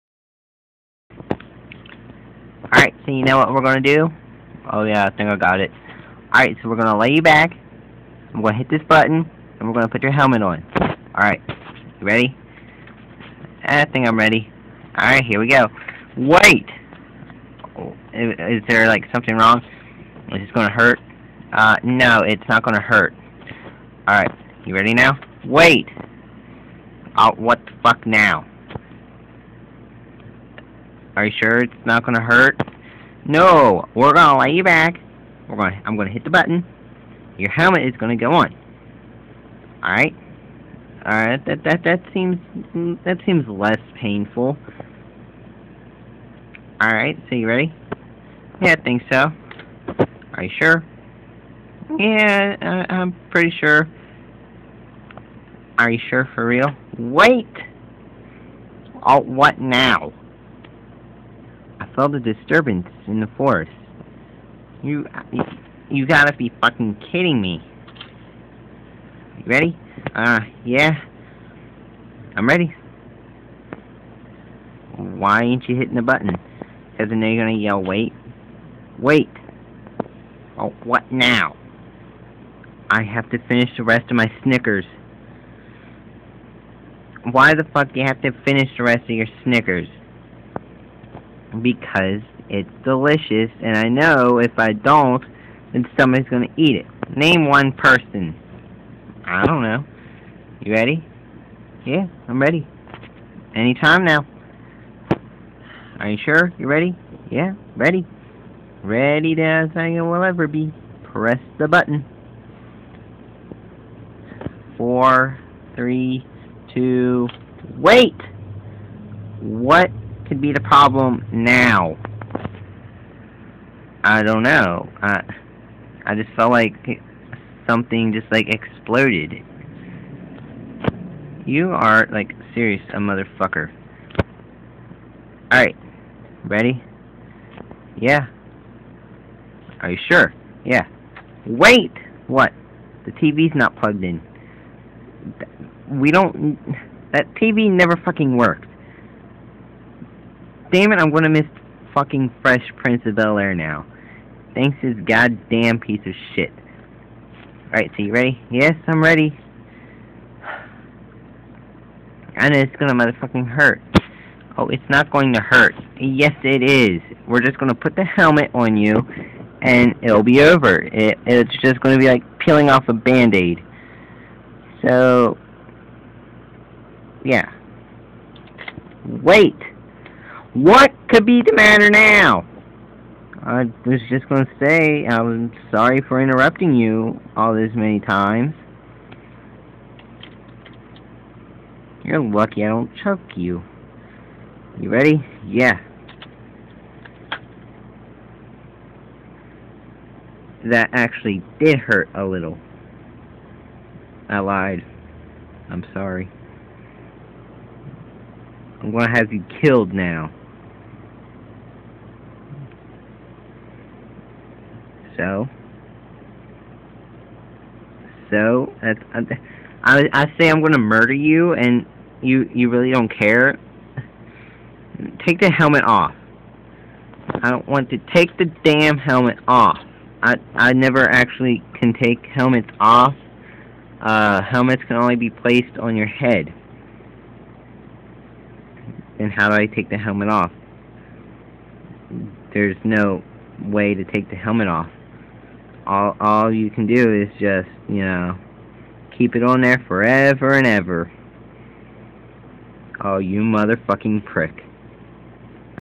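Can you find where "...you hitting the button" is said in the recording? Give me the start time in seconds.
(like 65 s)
75 s.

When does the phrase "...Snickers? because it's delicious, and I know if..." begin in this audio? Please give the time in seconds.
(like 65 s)
89 s.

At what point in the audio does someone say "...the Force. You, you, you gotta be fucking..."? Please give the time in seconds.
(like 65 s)
63 s.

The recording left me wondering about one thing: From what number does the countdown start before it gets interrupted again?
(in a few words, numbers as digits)
4.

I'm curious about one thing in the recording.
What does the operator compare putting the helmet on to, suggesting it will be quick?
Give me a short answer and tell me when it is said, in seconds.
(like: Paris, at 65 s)
peeling off a band-aid, at 172 s.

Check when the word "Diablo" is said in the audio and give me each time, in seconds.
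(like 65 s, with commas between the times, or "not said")
not said.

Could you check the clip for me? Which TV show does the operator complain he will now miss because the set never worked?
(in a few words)
Fresh Prince of Bel Air.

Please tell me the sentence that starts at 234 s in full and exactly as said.
Uh, helmets can only be placed on your head.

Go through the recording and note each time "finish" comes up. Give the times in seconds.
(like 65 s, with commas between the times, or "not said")
83 s, 88 s.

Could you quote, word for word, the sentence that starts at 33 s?
No, we're gonna lay you back.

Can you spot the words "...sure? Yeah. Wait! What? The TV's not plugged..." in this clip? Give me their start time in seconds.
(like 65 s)
140 s.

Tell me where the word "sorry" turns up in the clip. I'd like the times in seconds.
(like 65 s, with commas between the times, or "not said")
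185 s, 205 s.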